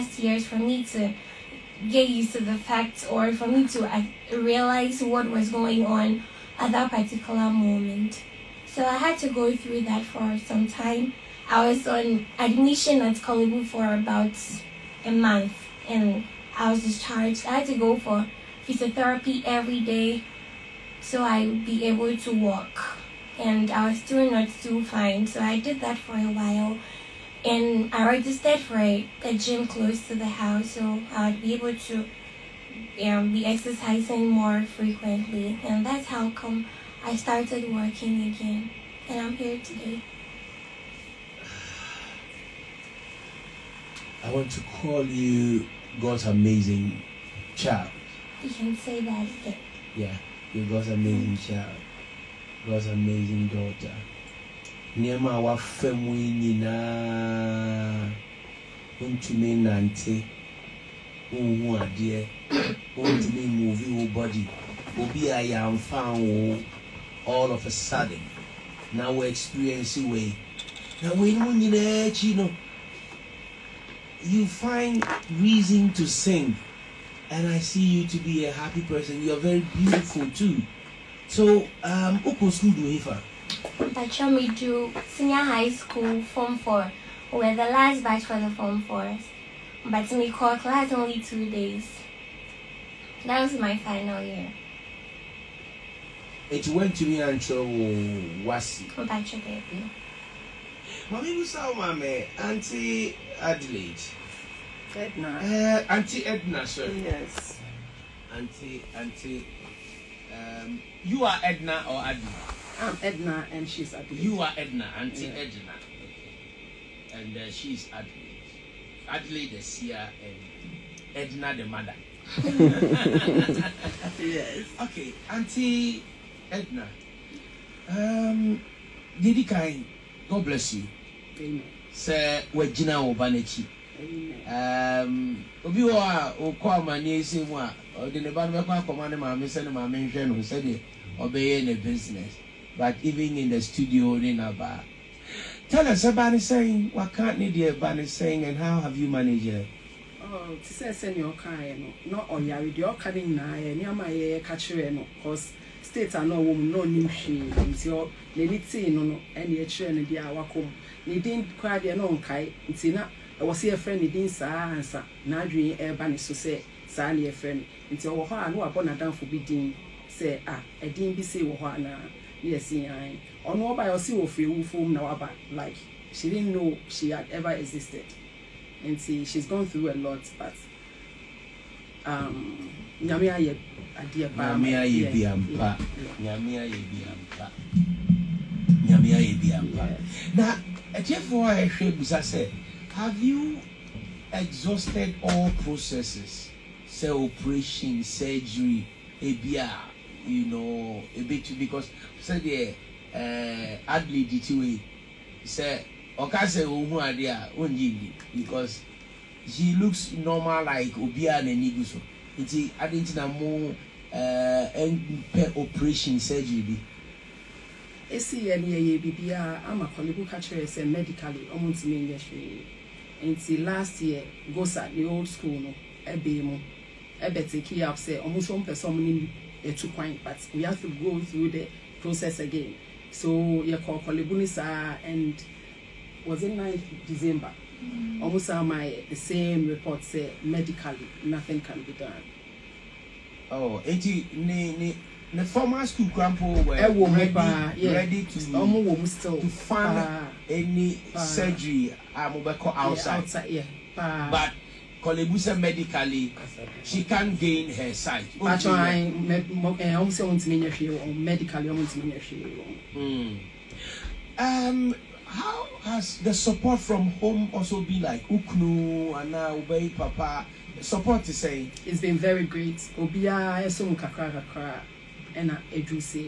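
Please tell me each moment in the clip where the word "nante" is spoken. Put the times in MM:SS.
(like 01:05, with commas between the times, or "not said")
00:59.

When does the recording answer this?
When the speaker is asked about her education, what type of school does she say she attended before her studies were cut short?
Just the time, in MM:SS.
01:25.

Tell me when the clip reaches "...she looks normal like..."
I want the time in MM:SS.
03:29.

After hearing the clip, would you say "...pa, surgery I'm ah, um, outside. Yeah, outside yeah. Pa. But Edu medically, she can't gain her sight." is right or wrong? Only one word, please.
wrong.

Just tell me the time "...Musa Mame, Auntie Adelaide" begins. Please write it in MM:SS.
01:41.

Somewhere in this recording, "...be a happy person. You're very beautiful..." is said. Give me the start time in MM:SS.
01:18.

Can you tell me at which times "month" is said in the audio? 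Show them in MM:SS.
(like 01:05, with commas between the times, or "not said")
00:15.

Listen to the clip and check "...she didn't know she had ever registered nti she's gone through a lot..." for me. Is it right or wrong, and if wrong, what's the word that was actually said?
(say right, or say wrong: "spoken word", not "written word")
wrong: "existed", not "registered".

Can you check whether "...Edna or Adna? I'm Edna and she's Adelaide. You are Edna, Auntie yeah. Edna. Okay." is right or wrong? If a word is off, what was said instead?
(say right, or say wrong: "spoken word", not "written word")
right.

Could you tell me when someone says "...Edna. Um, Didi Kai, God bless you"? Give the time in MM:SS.
02:06.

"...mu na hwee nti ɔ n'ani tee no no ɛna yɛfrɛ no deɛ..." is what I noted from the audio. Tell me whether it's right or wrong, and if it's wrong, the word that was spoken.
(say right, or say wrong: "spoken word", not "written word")
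wrong: "ɛkyerɛ", not "yɛfrɛ".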